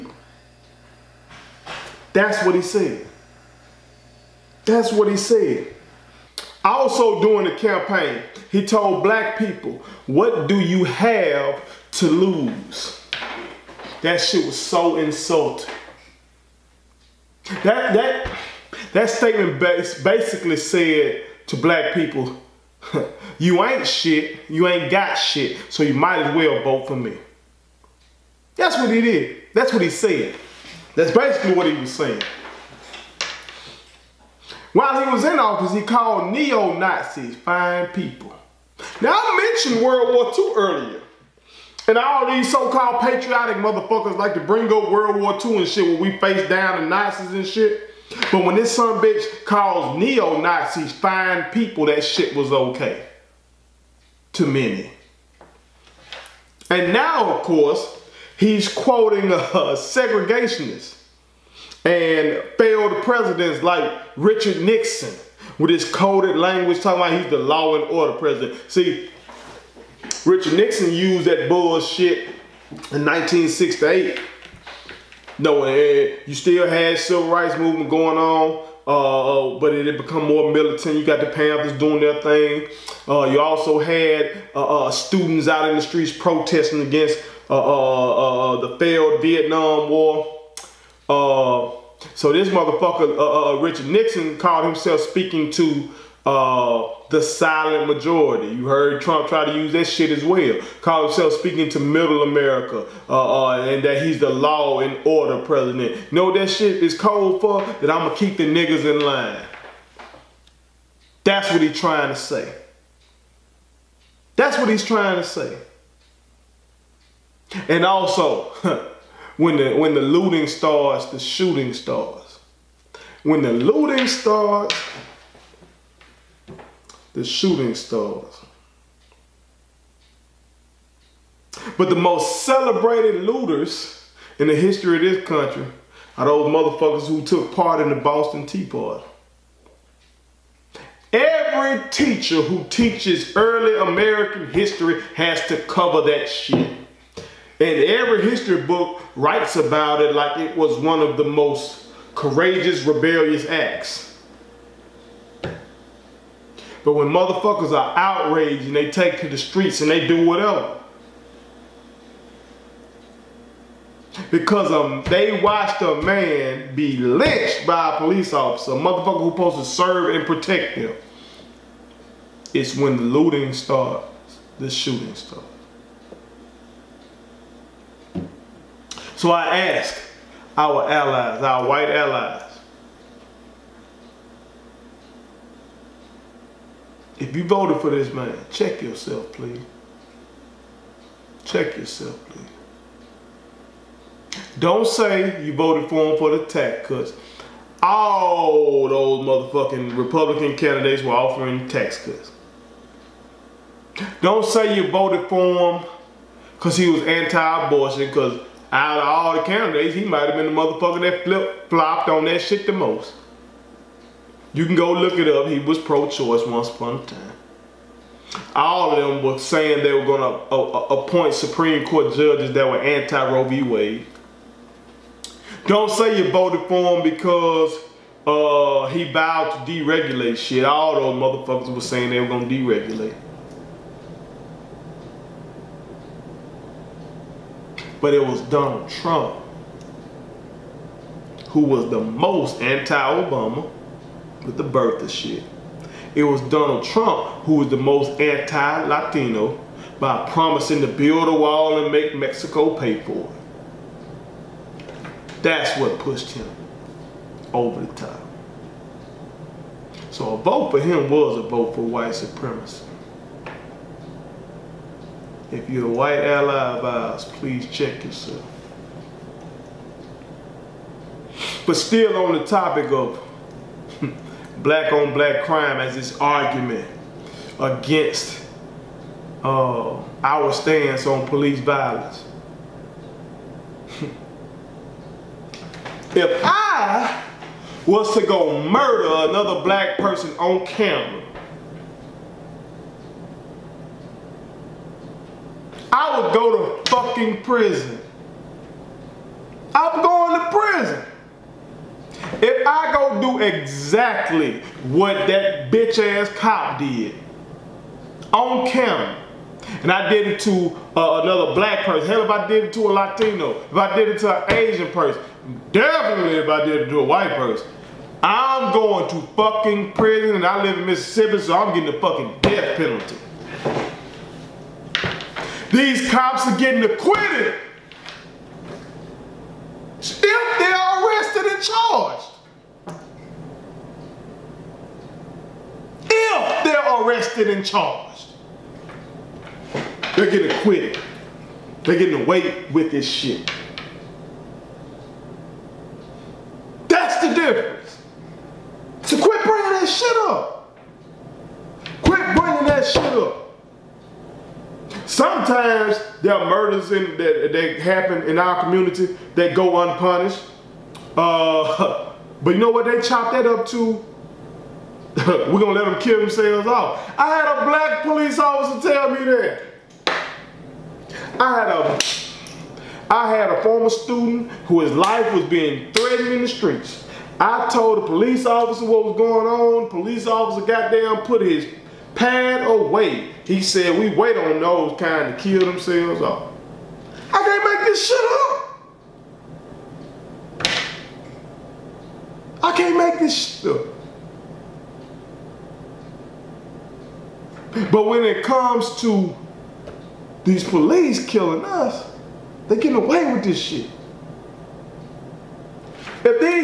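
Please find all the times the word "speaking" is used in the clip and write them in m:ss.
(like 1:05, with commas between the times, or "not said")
1:35, 1:41.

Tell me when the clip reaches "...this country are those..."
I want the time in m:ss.
2:15.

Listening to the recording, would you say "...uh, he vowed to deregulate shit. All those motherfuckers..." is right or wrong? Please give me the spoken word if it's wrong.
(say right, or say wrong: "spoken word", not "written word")
right.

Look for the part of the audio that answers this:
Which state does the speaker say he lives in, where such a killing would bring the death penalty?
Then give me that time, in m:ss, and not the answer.
5:20.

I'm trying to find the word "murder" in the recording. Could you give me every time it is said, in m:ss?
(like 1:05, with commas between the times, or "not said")
4:48, 5:56.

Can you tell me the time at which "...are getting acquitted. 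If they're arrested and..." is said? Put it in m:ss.
5:26.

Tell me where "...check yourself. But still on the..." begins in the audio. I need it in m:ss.
4:27.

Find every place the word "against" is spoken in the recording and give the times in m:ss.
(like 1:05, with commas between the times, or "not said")
1:26, 4:37.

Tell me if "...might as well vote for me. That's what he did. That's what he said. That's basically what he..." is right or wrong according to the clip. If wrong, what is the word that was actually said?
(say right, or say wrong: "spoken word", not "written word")
right.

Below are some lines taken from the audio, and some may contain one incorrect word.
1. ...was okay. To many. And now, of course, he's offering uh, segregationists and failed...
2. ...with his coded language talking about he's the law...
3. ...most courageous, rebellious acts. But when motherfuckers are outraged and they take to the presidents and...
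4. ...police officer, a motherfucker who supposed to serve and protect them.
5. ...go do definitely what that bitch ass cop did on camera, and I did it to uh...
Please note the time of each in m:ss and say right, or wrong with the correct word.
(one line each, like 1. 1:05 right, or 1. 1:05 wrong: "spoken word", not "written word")
1. 0:52 wrong: "quoting", not "offering"
2. 1:05 right
3. 2:31 wrong: "streets", not "presidents"
4. 2:47 right
5. 5:02 wrong: "exactly", not "definitely".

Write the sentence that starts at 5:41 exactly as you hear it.
They're getting away with this shit.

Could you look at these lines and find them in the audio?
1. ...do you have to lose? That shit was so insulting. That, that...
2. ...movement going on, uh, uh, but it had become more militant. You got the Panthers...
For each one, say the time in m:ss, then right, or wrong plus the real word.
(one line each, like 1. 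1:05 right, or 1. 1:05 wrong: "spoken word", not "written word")
1. 0:10 right
2. 1:17 right.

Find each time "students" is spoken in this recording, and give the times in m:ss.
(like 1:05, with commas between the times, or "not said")
1:24, 6:13.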